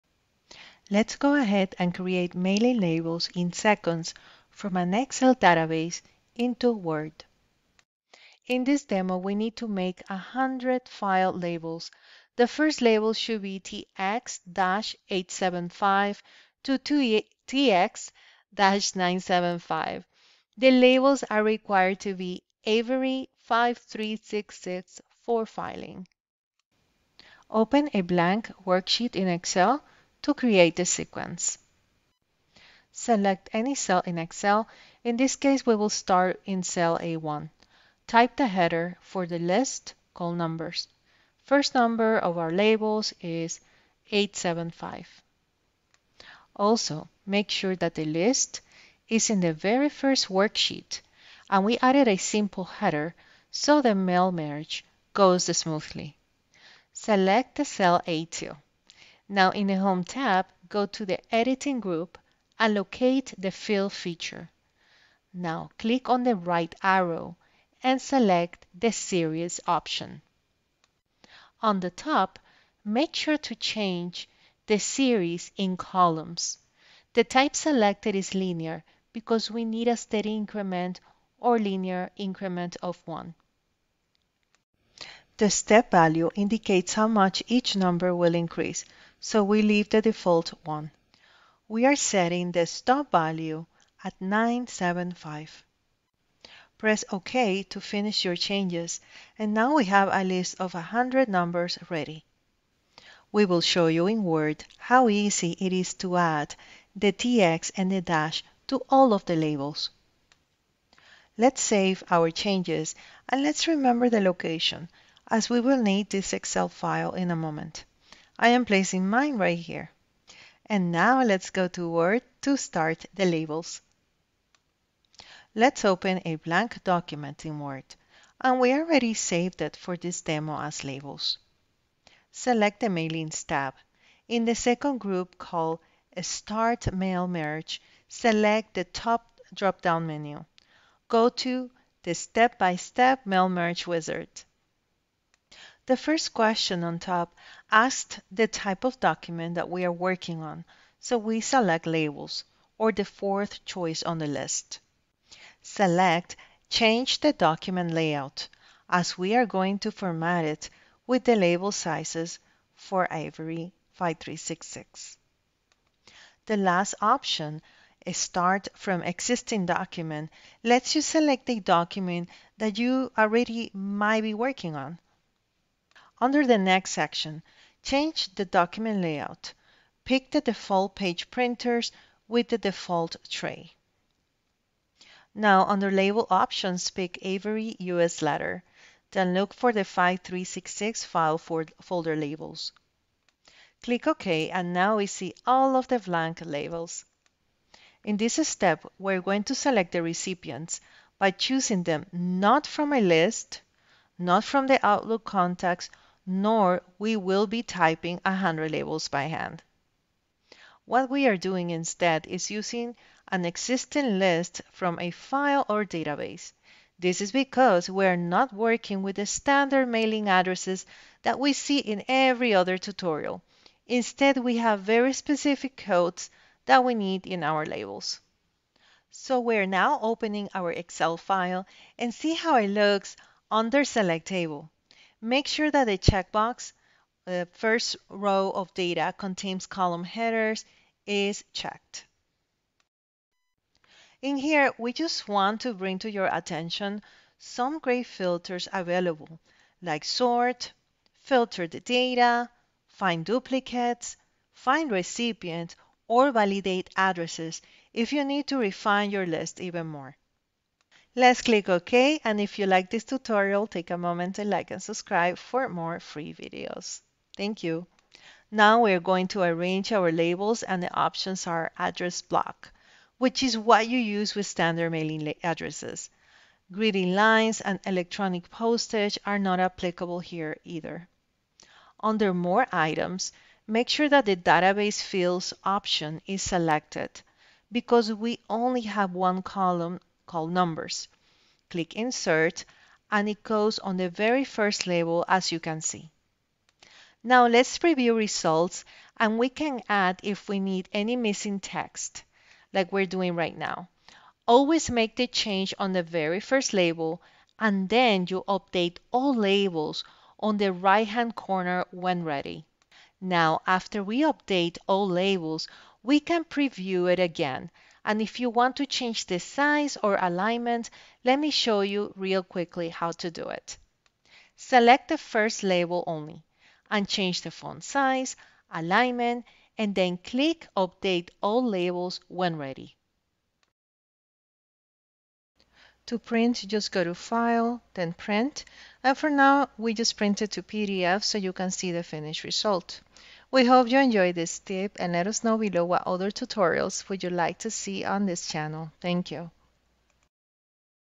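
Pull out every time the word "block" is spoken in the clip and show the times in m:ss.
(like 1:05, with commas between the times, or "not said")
4:32.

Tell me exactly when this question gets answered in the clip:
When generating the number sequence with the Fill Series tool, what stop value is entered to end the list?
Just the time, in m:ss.
1:34.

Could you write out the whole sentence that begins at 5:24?
Select the first label only and change the font size, alignment, and then click Update All Labels when ready.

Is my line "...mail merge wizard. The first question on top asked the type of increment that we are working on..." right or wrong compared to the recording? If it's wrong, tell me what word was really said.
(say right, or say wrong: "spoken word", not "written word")
wrong: "document", not "increment".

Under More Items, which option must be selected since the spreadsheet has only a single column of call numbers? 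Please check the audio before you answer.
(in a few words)
Database Fields.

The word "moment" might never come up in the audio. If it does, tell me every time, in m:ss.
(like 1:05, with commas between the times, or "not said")
1:57, 4:23.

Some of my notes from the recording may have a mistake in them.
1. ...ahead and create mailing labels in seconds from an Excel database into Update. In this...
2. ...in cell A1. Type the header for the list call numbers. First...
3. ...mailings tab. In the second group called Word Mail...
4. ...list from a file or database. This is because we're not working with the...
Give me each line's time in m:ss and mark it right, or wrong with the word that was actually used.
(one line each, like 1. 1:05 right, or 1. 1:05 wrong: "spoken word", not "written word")
1. 0:01 wrong: "Word", not "Update"
2. 0:36 right
3. 2:12 wrong: "Start", not "Word"
4. 3:34 right.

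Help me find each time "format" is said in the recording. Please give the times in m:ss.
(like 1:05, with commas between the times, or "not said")
2:39.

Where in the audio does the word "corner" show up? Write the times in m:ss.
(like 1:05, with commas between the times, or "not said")
5:11.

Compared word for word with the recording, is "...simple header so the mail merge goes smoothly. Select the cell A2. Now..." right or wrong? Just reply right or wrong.
right.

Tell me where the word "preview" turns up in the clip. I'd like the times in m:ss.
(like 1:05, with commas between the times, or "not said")
4:57, 5:16.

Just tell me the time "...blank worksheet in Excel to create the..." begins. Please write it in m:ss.
0:28.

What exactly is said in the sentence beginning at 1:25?
The step value indicates how much each number will increase, so we leave the default 1.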